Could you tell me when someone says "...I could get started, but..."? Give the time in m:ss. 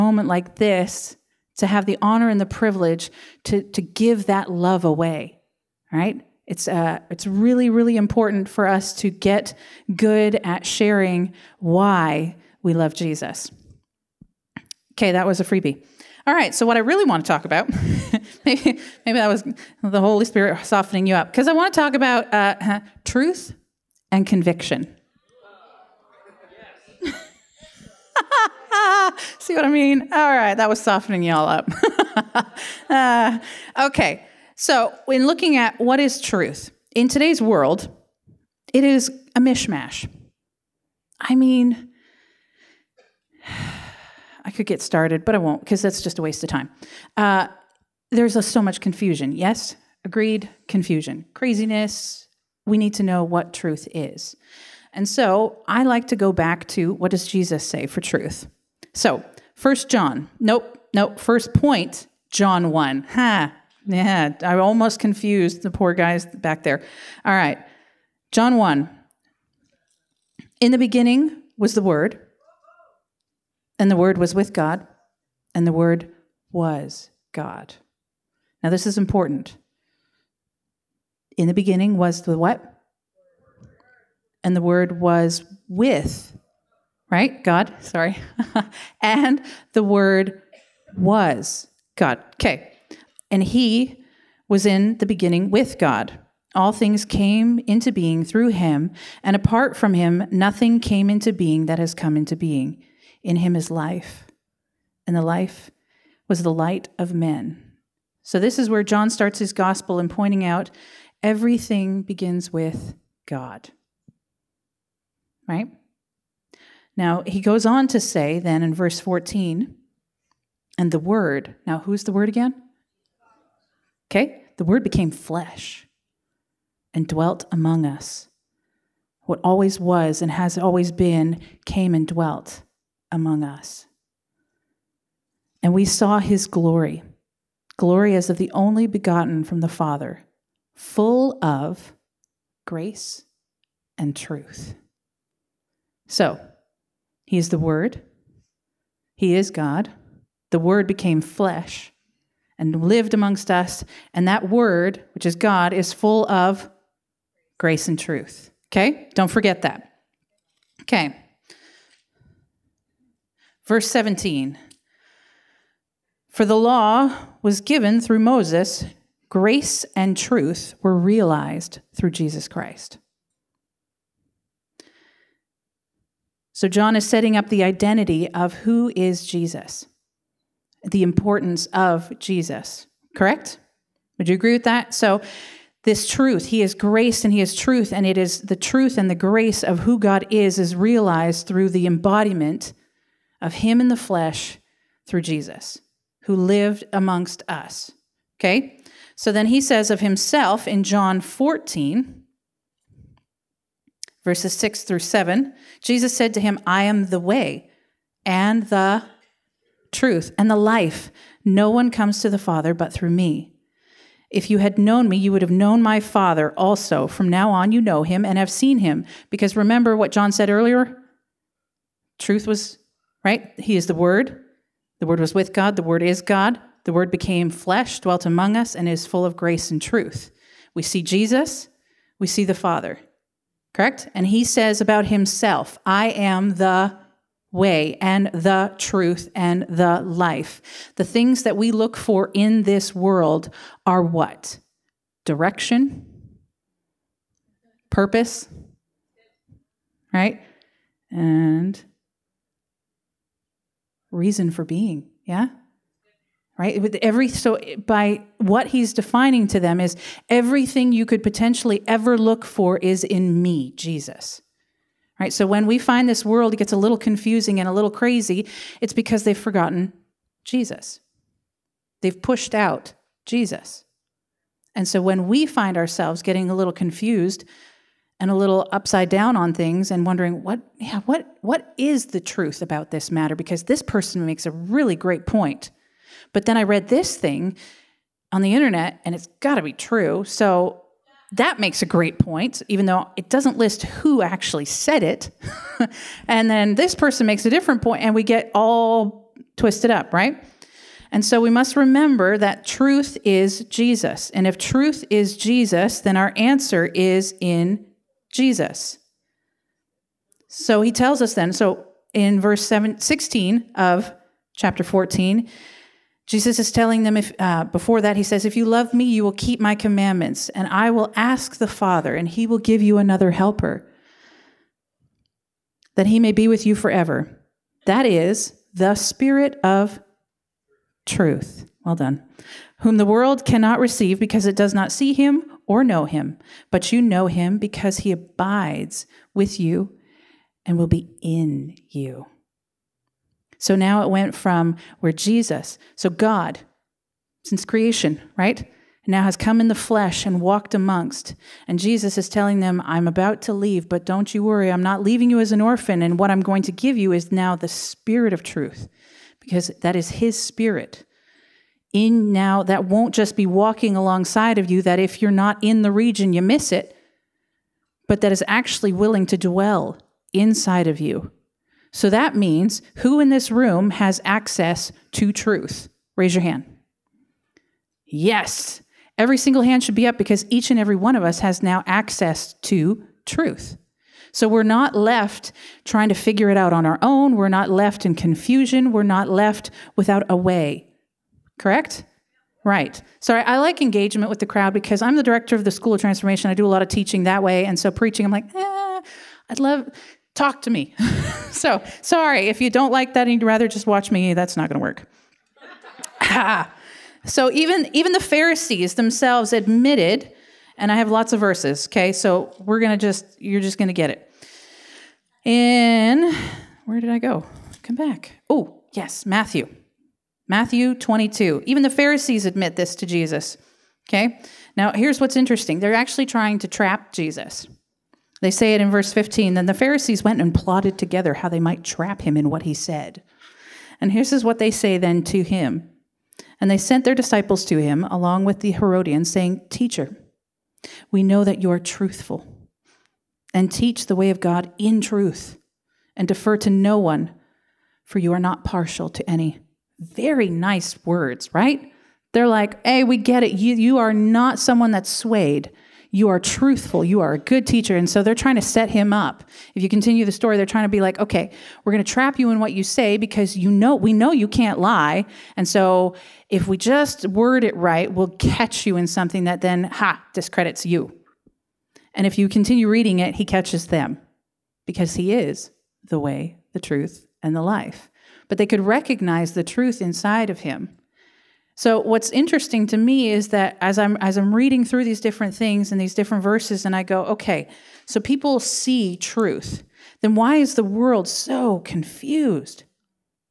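0:44.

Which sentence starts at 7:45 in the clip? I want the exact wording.
And so if we just word it right, we'll catch you in something that then, ha, discredits you.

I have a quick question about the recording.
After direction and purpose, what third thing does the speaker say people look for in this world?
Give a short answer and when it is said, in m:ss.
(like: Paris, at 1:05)
reason for being, at 4:14.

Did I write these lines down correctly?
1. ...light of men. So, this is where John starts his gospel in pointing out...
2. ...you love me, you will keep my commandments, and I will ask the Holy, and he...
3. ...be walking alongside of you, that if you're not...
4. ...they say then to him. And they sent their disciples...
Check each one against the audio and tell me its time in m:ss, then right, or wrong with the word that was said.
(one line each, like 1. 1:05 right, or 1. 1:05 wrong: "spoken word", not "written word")
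1. 1:46 right
2. 5:18 wrong: "Father", not "Holy"
3. 6:03 right
4. 7:14 right.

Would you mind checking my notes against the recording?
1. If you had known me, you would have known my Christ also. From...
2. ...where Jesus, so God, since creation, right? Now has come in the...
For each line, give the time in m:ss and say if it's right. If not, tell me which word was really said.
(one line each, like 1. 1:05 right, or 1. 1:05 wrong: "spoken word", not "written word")
1. 3:34 wrong: "Father", not "Christ"
2. 5:44 right.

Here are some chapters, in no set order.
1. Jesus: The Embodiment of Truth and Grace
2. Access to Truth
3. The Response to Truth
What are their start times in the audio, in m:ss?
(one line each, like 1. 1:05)
1. 2:05
2. 5:18
3. 7:49.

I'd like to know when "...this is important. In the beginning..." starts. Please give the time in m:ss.
1:18.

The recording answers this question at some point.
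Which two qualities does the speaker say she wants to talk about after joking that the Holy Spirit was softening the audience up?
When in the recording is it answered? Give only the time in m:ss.
0:23.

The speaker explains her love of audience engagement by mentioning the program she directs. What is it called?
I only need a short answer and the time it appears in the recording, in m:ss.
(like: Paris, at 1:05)
School of Transformation, at 6:35.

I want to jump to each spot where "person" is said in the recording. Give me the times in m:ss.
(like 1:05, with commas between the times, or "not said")
4:43, 4:56.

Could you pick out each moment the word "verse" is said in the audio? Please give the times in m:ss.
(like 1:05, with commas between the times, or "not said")
1:58, 2:43, 3:24, 5:12, 6:51, 7:08, 8:06.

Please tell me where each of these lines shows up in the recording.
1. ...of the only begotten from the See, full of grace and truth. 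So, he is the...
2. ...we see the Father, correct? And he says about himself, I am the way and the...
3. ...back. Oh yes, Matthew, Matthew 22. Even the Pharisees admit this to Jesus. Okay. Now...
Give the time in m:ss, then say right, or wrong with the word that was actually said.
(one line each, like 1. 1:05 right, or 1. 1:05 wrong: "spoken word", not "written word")
1. 2:18 wrong: "Father", not "See"
2. 3:52 right
3. 6:57 right.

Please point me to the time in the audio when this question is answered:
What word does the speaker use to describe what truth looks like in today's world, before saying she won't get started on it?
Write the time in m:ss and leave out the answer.
0:39.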